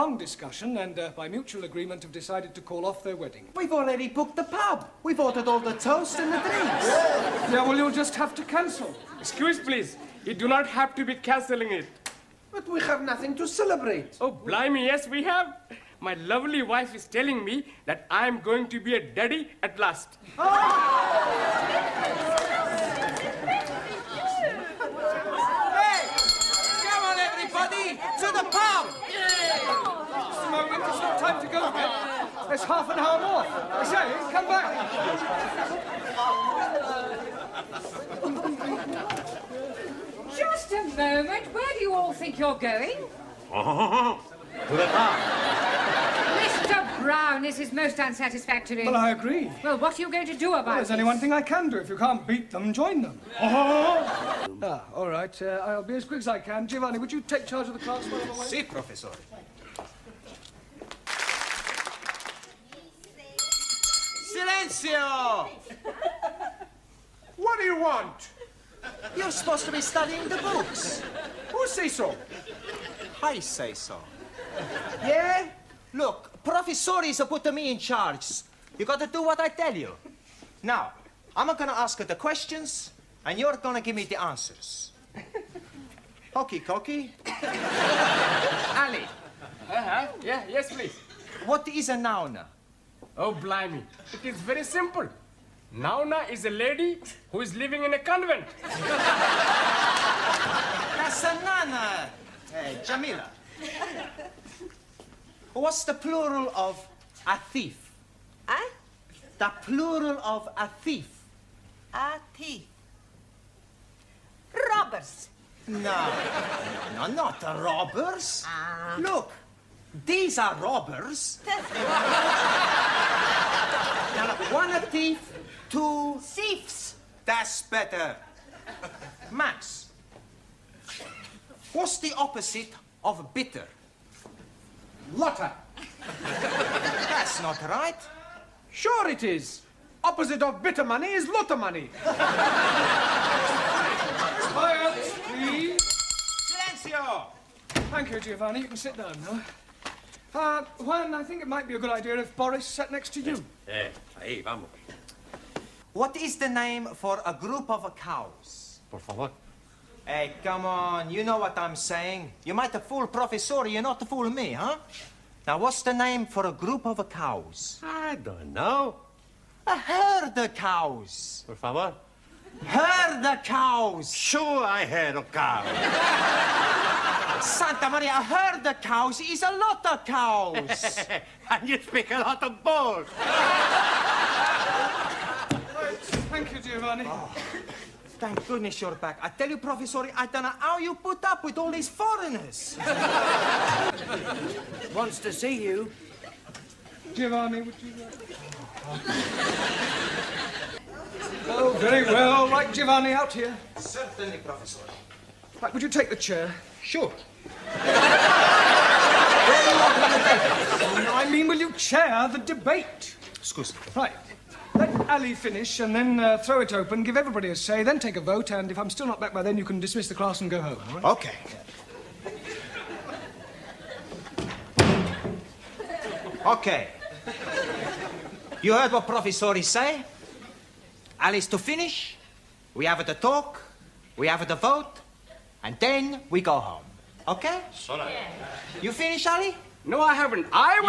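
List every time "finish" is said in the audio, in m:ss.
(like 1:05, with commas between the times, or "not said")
3:35, 3:51, 3:58.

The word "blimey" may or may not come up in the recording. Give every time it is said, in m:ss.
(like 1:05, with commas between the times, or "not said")
0:14, 1:33.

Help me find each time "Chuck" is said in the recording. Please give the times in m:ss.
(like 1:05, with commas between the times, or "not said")
not said.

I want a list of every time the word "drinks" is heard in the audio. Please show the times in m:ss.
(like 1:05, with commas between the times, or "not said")
0:06.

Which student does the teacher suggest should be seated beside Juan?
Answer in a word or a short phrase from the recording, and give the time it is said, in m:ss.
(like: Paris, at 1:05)
Boris, at 2:32.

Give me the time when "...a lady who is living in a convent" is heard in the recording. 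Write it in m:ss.
1:36.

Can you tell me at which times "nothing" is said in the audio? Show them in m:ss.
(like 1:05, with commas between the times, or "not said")
0:13.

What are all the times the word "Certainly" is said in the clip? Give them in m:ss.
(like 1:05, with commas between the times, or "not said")
3:23.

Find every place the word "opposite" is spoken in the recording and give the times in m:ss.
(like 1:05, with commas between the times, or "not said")
2:12, 2:20.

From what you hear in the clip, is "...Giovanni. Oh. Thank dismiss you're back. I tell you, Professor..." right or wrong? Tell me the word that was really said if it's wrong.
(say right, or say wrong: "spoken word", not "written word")
wrong: "goodness", not "dismiss".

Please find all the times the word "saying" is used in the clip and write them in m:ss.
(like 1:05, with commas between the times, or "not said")
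2:41.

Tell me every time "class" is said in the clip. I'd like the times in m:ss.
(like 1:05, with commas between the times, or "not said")
0:57, 3:40.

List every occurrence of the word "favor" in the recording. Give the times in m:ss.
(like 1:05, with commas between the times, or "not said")
2:39, 2:51.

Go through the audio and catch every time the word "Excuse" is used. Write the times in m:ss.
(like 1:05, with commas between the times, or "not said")
0:09, 3:33.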